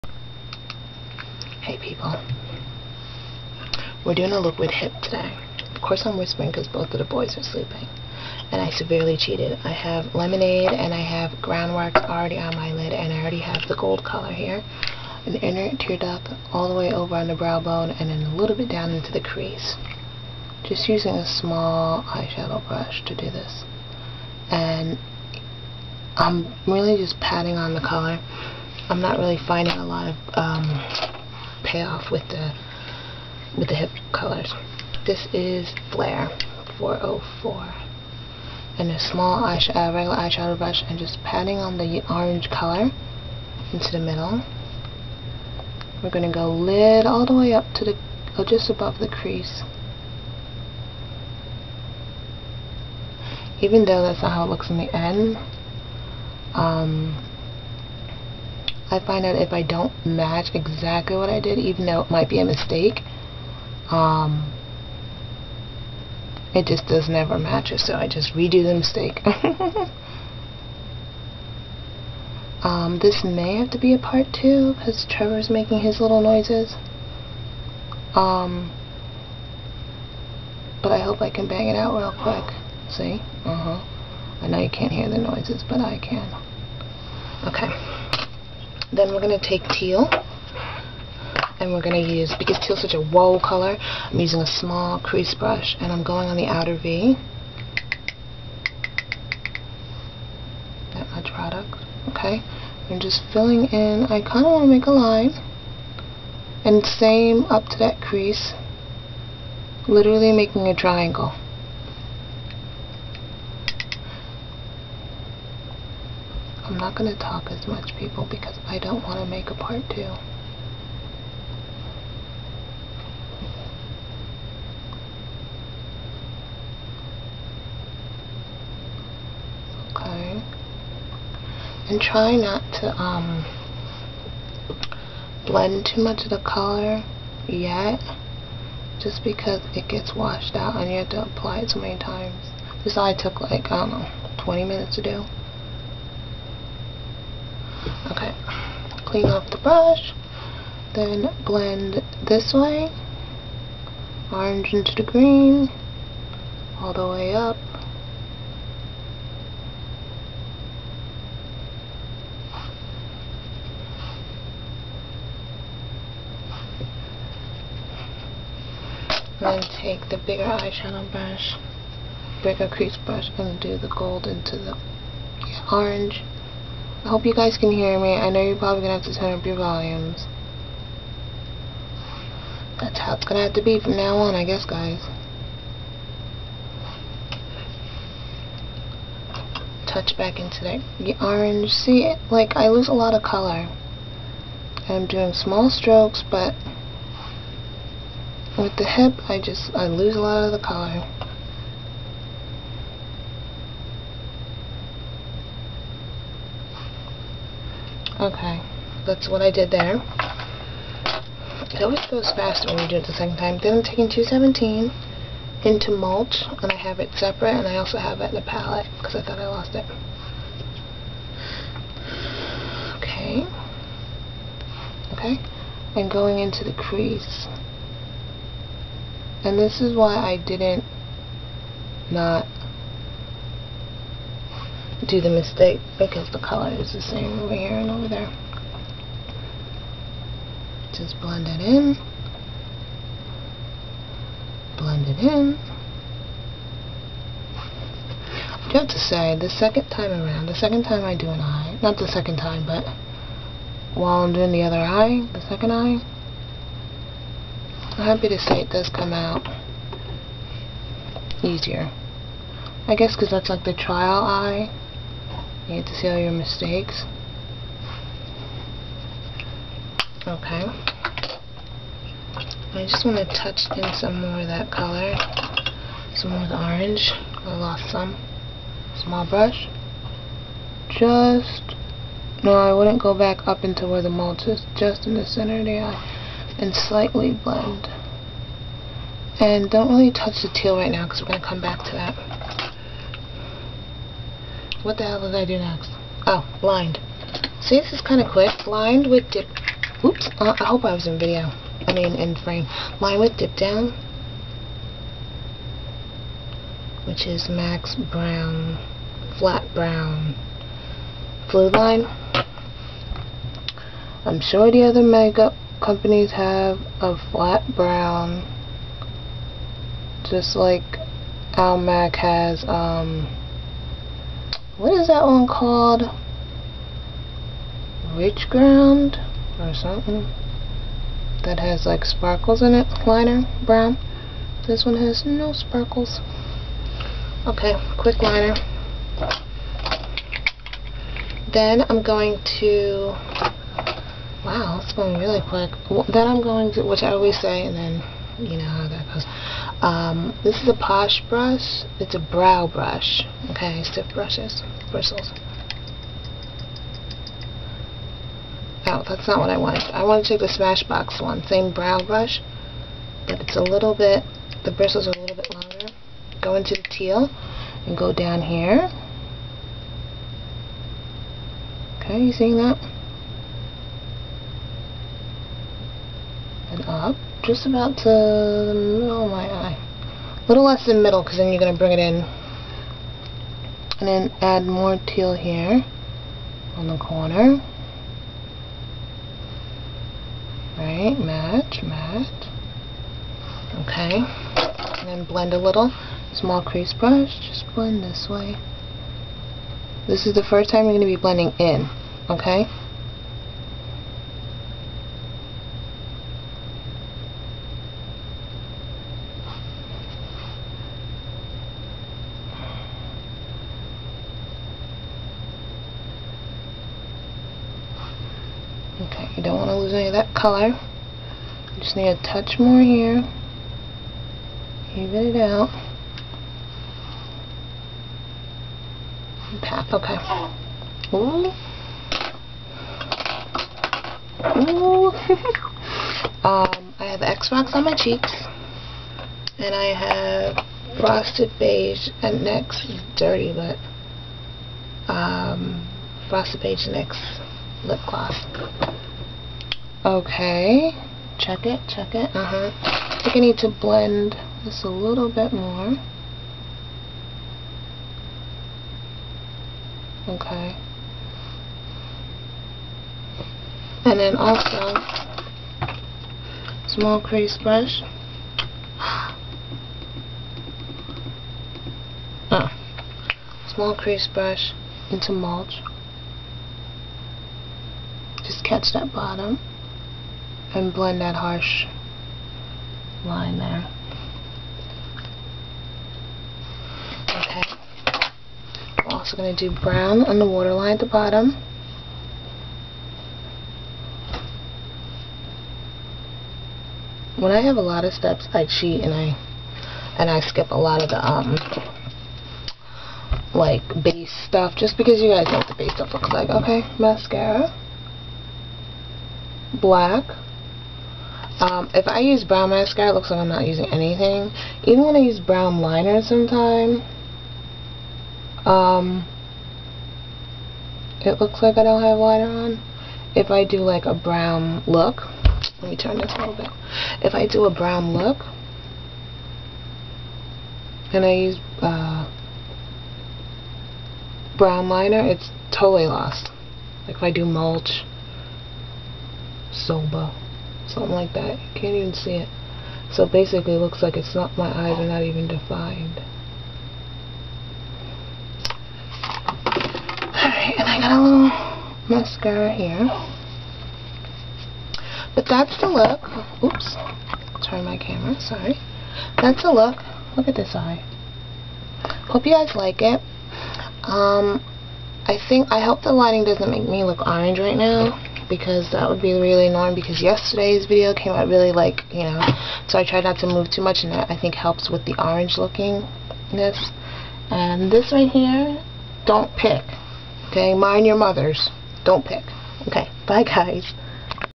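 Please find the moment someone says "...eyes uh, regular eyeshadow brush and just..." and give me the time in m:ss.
0:39.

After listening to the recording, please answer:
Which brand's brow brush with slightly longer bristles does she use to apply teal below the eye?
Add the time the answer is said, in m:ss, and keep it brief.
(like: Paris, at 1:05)
Smashbox, at 6:00.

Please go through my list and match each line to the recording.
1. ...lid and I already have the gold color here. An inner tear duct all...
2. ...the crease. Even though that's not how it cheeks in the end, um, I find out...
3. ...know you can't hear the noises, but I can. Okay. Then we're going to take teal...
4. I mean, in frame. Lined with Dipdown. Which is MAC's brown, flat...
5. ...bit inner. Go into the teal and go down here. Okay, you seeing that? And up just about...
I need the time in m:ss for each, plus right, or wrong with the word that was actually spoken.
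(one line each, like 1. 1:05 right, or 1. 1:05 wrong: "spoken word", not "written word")
1. 0:12 right
2. 0:48 wrong: "looks", not "cheeks"
3. 1:24 right
4. 5:01 right
5. 6:05 wrong: "longer", not "inner".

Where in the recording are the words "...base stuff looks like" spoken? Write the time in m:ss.
8:25.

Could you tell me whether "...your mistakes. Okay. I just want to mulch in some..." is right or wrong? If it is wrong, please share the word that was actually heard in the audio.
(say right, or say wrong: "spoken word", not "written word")
wrong: "touch", not "mulch".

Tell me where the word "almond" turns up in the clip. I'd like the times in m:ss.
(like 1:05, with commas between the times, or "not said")
not said.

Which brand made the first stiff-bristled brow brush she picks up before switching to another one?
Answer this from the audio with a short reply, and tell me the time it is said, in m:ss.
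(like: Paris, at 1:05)
Posh, at 5:50.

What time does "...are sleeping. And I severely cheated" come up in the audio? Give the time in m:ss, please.
0:07.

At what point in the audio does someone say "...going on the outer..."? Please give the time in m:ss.
1:36.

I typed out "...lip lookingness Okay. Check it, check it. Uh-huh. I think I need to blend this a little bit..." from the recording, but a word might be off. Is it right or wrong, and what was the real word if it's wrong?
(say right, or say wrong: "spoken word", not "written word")
wrong: "gloss", not "lookingness".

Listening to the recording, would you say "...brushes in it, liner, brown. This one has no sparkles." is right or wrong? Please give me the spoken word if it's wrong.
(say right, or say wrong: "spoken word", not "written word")
wrong: "sparkles", not "brushes".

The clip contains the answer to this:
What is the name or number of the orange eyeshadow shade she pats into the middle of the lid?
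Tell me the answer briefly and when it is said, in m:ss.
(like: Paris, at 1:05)
Flare 404, at 0:35.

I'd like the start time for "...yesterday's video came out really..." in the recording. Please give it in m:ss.
9:30.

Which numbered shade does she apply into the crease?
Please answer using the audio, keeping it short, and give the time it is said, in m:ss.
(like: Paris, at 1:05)
217, at 3:34.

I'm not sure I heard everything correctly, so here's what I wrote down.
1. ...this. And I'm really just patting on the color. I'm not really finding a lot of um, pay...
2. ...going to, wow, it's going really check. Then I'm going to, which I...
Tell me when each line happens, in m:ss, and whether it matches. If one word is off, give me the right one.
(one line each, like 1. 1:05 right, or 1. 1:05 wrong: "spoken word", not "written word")
1. 0:23 right
2. 5:42 wrong: "quick", not "check".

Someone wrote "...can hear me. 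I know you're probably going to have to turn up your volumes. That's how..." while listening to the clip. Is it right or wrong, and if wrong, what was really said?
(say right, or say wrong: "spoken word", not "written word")
right.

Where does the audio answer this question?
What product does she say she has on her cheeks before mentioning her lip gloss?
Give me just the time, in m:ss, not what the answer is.
7:17.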